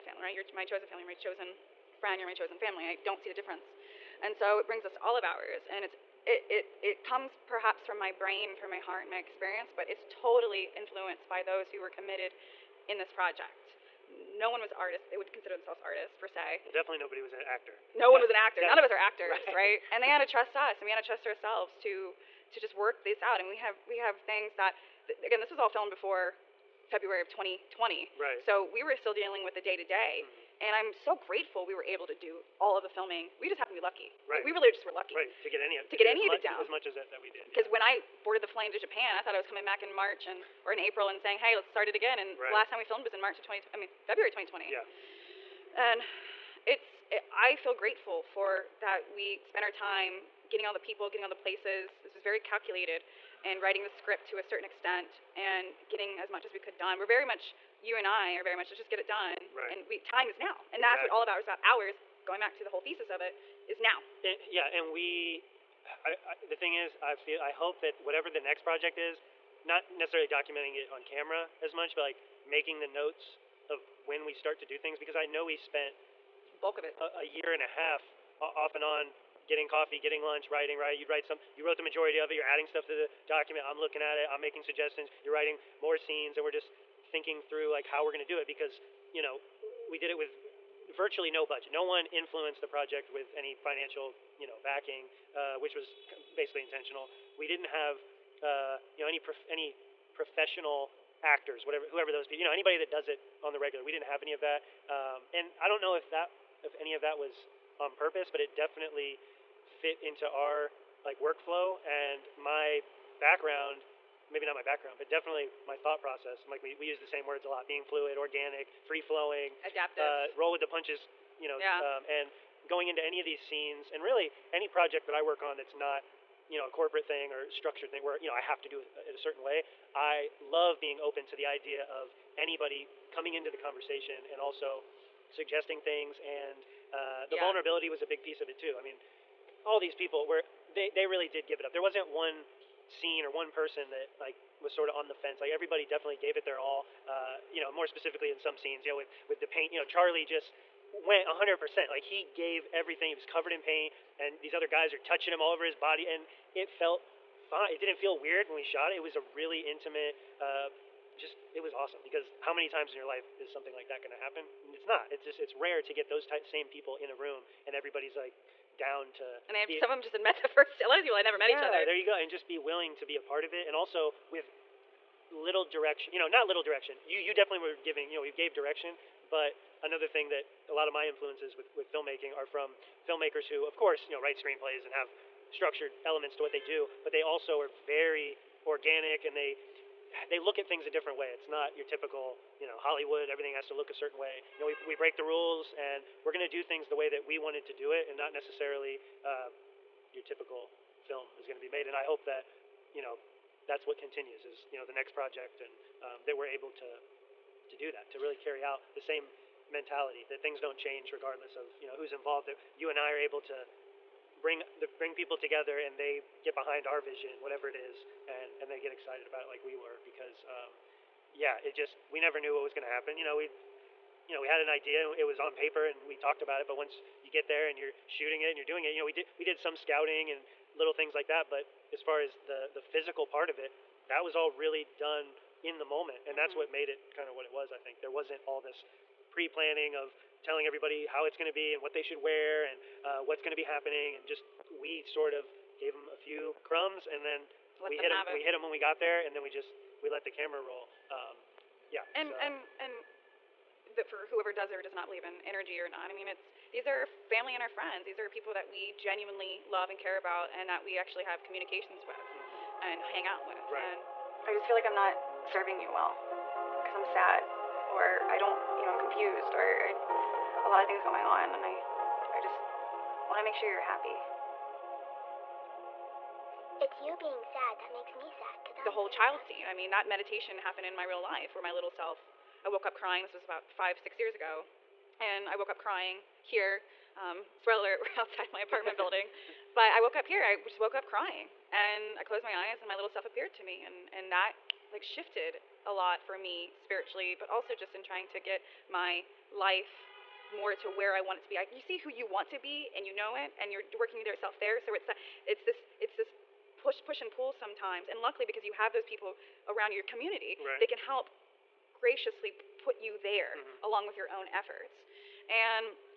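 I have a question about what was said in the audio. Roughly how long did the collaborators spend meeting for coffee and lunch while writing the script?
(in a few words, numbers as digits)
a year and a half.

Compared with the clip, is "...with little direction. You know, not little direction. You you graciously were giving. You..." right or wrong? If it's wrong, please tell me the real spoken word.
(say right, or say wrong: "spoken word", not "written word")
wrong: "definitely", not "graciously".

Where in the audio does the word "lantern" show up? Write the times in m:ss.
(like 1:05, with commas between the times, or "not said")
not said.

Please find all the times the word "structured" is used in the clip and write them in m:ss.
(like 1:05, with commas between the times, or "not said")
2:07, 3:05.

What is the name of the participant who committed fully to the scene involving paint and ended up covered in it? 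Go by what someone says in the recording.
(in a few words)
Charlie.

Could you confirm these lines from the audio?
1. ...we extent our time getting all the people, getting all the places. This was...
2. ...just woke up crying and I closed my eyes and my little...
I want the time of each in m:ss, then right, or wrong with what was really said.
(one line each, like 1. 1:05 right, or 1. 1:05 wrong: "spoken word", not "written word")
1. 0:49 wrong: "spent", not "extent"
2. 4:50 right.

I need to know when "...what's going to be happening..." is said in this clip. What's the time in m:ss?
4:03.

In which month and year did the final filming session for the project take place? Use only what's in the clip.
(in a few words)
February 2020.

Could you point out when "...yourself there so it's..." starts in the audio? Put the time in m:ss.
5:04.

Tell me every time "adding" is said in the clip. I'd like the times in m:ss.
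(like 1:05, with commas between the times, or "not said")
1:22.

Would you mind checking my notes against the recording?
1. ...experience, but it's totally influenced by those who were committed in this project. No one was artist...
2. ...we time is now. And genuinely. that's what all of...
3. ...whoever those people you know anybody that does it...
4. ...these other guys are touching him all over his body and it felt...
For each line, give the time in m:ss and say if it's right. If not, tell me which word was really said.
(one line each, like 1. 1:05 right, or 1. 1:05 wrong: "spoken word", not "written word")
1. 0:09 right
2. 0:59 wrong: "exactly", not "genuinely"
3. 1:41 right
4. 2:34 right.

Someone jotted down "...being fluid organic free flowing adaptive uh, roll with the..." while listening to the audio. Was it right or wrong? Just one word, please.
right.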